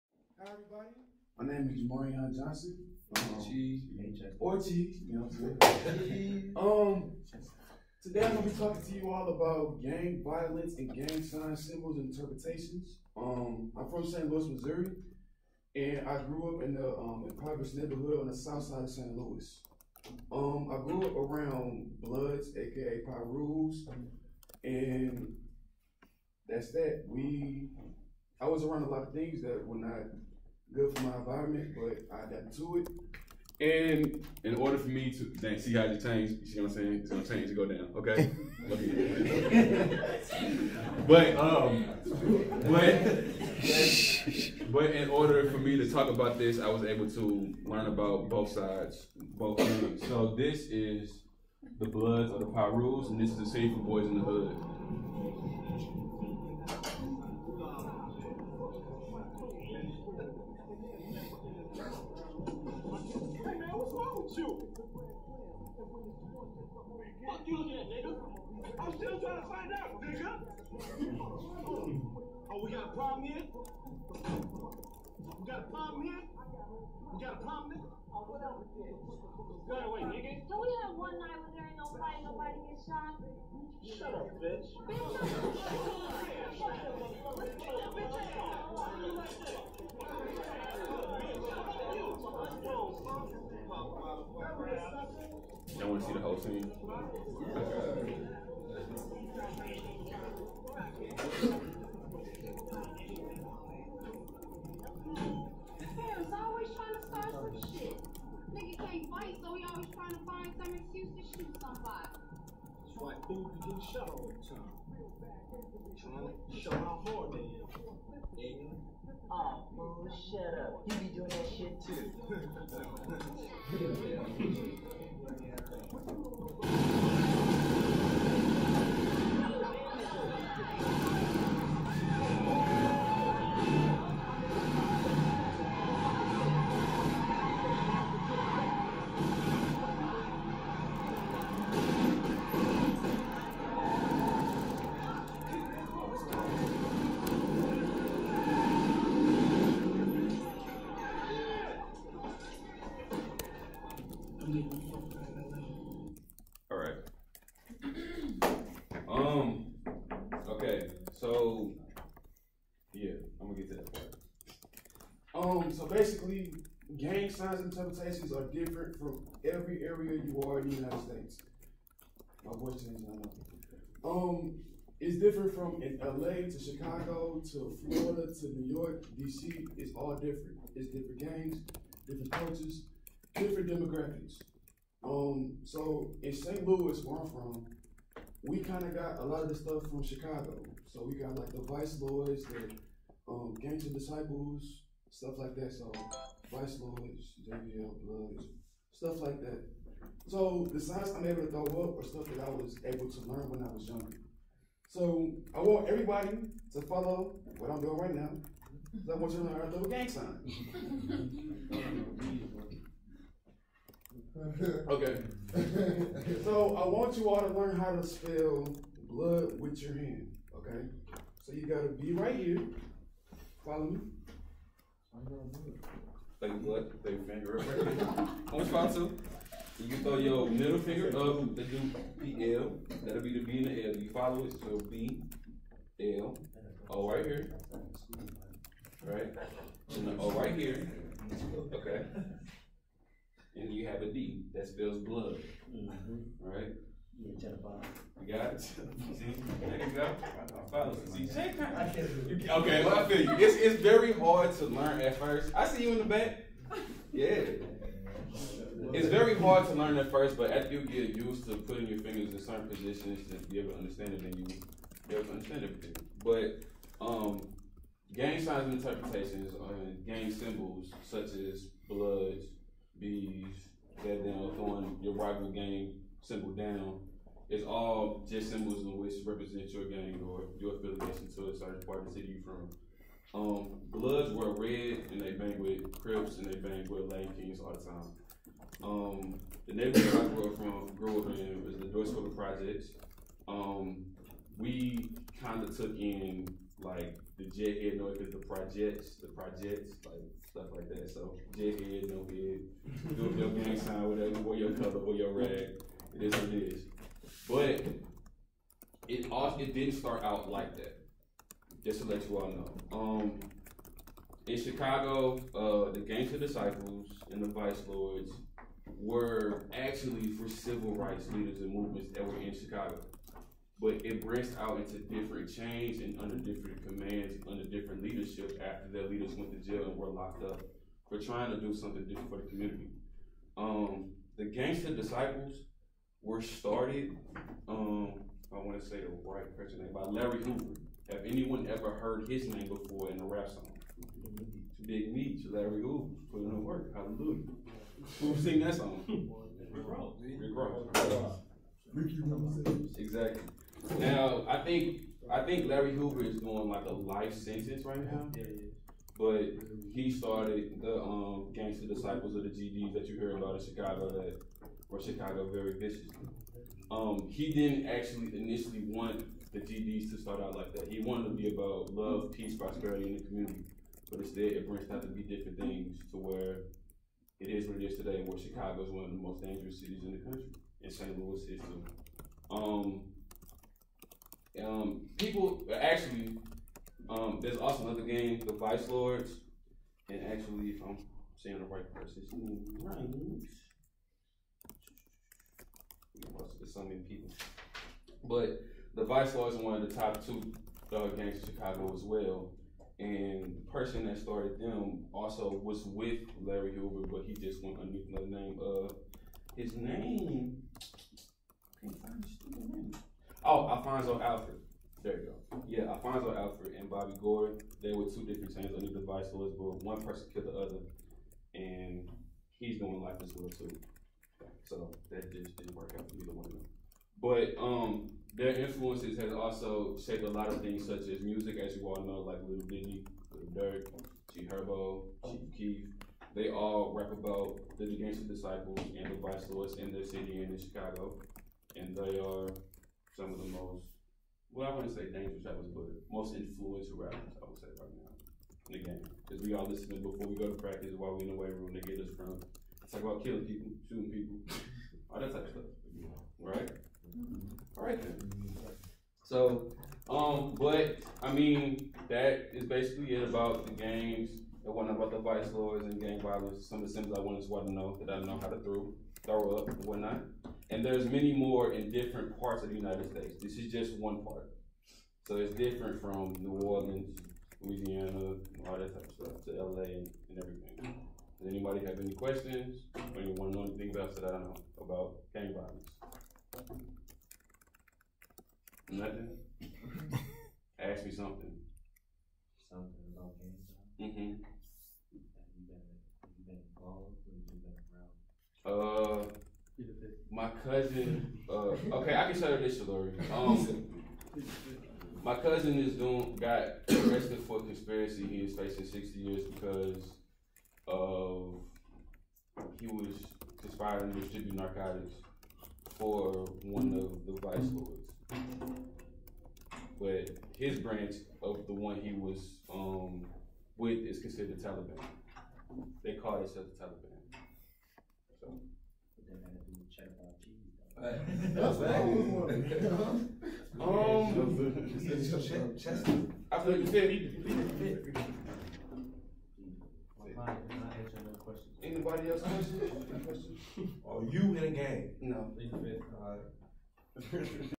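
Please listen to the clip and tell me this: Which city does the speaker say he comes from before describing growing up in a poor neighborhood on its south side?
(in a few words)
St. Louis, Missouri.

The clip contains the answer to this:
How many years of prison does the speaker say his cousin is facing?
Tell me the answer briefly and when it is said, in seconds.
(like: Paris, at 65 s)
60, at 508 s.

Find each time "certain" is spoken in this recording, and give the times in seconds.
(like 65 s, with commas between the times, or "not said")
262 s, 281 s.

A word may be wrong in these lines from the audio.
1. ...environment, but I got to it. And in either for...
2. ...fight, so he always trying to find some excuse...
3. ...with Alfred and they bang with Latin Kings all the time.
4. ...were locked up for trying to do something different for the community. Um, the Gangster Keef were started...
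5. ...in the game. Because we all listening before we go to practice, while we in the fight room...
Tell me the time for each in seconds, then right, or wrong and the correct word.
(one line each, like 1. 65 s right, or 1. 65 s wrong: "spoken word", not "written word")
1. 31 s wrong: "order", not "either"
2. 109 s right
3. 285 s wrong: "Crips", not "Alfred"
4. 329 s wrong: "Disciples", not "Keef"
5. 448 s wrong: "weight", not "fight".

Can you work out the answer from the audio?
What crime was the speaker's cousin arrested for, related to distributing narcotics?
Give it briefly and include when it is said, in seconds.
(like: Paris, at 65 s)
Conspiracy, at 507 s.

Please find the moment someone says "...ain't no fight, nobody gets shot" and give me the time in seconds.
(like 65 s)
81 s.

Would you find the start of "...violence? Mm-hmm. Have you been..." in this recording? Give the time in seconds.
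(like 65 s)
493 s.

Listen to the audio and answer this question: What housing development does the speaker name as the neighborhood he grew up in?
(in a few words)
North School Projects.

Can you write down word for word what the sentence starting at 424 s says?
So that just didn't work out for either one of them.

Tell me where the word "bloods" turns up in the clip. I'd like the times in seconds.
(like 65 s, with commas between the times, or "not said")
22 s, 51 s, 198 s, 219 s, 226 s, 244 s, 271 s, 283 s.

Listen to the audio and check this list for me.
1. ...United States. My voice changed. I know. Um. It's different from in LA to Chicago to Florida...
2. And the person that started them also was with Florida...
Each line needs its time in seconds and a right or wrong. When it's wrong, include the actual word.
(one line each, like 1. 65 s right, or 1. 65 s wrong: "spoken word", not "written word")
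1. 170 s right
2. 402 s wrong: "Larry", not "Florida".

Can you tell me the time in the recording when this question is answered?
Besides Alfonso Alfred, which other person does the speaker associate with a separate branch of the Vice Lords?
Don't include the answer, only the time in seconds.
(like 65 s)
416 s.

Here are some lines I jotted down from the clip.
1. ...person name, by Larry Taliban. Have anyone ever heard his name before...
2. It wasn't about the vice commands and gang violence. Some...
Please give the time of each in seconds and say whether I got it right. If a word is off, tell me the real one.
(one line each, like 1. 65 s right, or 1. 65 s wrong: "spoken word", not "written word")
1. 339 s wrong: "Hoover", not "Taliban"
2. 464 s wrong: "lords", not "commands".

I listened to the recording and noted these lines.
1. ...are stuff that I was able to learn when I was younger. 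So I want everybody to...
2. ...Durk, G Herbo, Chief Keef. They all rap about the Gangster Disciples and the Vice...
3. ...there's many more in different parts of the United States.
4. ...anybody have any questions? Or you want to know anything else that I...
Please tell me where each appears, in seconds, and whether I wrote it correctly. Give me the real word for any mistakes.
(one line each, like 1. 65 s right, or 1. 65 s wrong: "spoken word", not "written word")
1. 201 s right
2. 433 s right
3. 470 s right
4. 481 s right.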